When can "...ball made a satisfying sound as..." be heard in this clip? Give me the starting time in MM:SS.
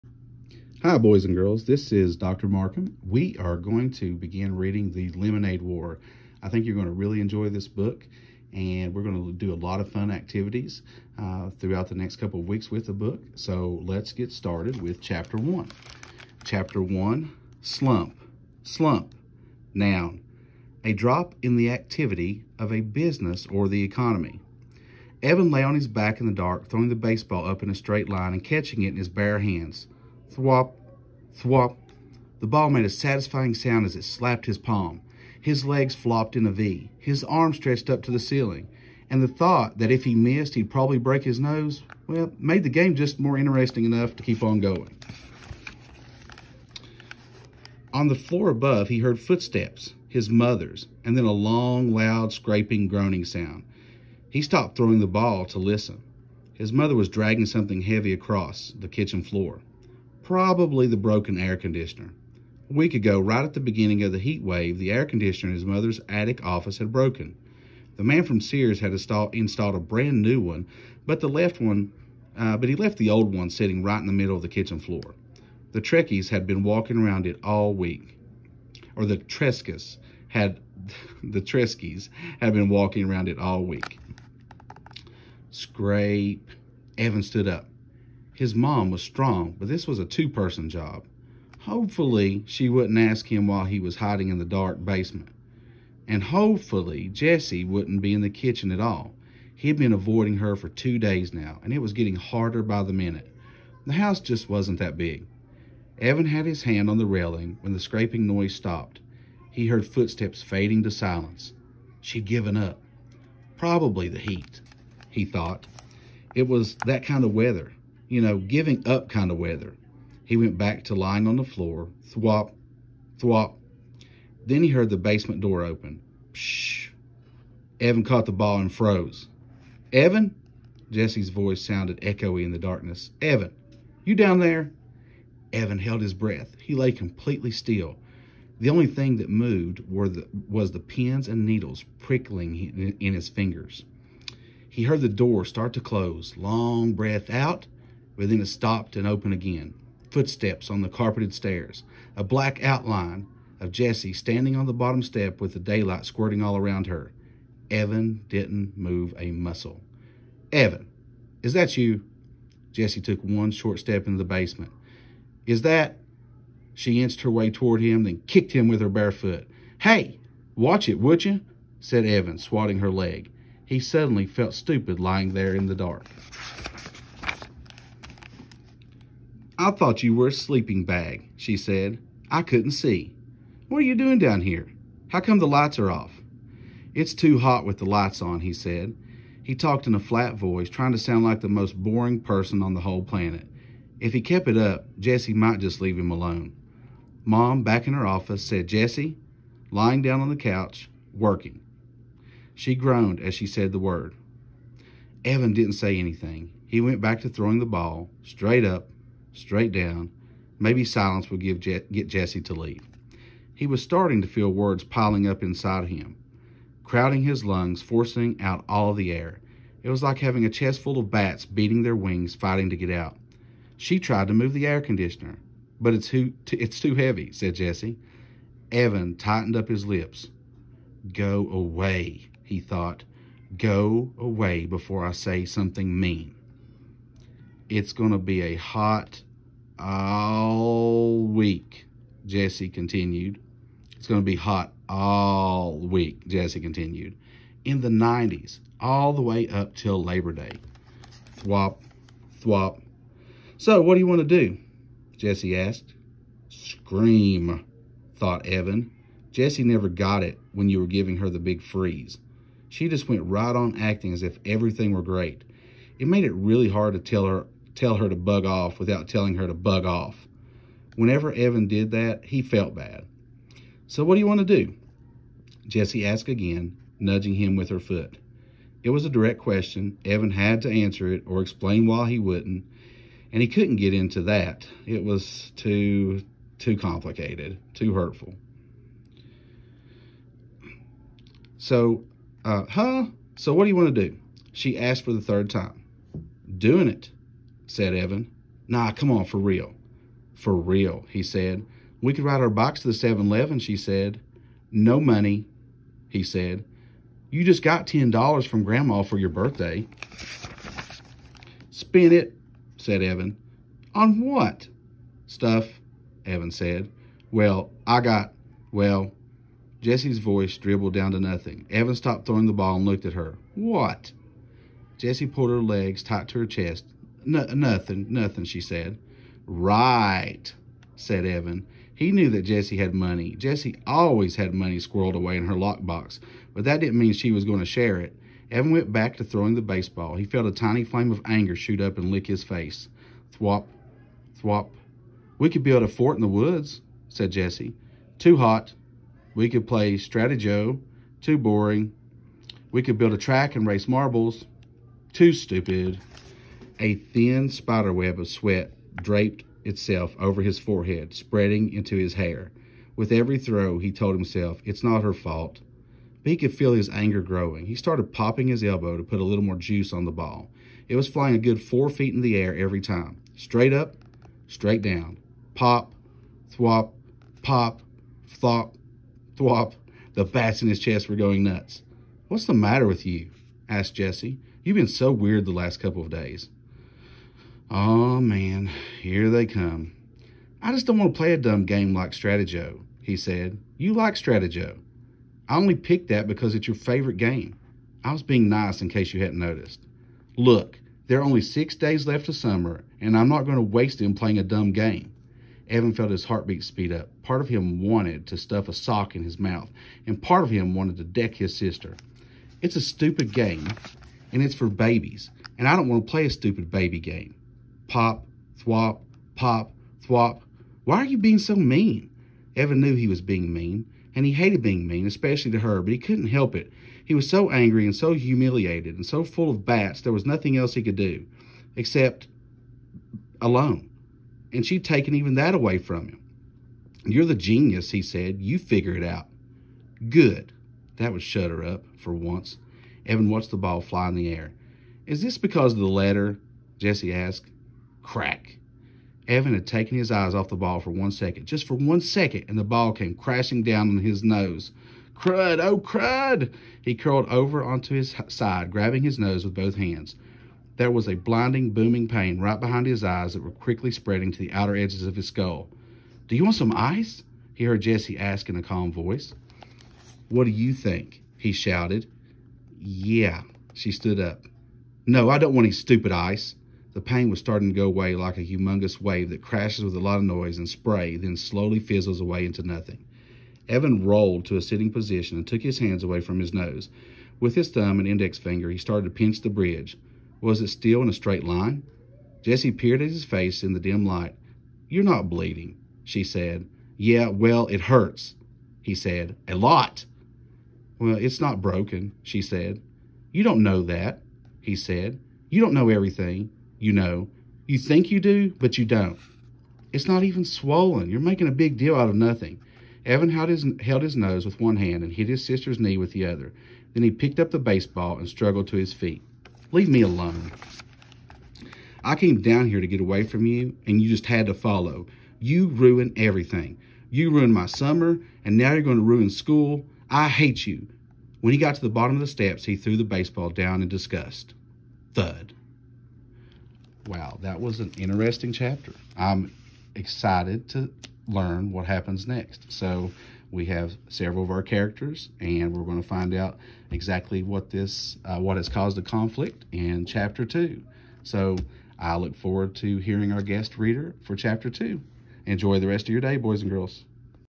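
00:32.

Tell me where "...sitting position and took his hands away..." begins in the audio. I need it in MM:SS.
08:04.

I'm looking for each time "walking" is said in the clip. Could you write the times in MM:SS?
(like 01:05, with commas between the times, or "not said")
01:16, 01:22.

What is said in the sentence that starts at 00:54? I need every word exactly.
He stopped throwing the ball to listen.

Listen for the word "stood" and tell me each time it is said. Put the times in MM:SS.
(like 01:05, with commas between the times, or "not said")
01:27, 07:53.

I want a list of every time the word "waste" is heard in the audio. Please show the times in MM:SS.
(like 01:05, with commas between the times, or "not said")
06:43.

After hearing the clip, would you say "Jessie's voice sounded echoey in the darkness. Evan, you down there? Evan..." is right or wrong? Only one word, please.
right.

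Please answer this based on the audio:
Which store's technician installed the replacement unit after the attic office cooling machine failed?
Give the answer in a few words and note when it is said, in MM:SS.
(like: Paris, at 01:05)
Sears, at 01:08.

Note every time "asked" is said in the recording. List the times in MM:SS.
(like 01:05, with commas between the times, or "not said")
04:15, 04:36, 04:54, 06:23, 07:27.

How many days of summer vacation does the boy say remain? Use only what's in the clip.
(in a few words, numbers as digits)
6.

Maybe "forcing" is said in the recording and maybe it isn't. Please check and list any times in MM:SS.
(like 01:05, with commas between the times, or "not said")
03:37.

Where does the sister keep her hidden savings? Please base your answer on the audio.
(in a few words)
lockbox.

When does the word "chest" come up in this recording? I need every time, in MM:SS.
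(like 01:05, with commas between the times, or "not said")
03:40, 05:26, 06:20.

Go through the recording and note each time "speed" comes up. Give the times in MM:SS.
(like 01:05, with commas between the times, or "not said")
06:46.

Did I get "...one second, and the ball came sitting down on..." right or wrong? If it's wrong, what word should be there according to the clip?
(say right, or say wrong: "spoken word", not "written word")
wrong: "crashing", not "sitting".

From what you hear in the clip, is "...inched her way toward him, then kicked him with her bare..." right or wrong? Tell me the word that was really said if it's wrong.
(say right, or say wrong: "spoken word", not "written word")
right.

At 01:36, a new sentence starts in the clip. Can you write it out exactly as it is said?
And hopefully, Jessie wouldn't be in the kitchen at all.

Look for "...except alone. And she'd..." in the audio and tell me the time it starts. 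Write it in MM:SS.
07:11.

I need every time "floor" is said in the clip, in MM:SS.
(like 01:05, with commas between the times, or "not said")
00:48, 00:59, 01:14, 02:01.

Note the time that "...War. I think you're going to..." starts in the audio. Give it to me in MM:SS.
00:05.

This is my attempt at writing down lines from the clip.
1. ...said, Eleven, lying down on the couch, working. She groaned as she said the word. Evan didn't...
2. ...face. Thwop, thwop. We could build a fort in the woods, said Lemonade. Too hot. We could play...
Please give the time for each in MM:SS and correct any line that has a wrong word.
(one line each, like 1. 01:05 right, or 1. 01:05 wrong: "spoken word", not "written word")
1. 03:18 wrong: "Jessie", not "Eleven"
2. 05:42 wrong: "Jessie", not "Lemonade".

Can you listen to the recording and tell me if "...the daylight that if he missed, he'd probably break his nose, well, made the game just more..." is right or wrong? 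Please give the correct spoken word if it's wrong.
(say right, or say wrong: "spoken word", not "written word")
wrong: "thought", not "daylight".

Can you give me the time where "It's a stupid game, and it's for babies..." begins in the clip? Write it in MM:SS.
06:52.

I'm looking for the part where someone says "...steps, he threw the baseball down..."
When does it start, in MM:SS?
08:52.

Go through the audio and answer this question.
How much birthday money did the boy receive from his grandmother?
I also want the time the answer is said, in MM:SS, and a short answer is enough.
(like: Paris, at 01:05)
$10, at 05:07.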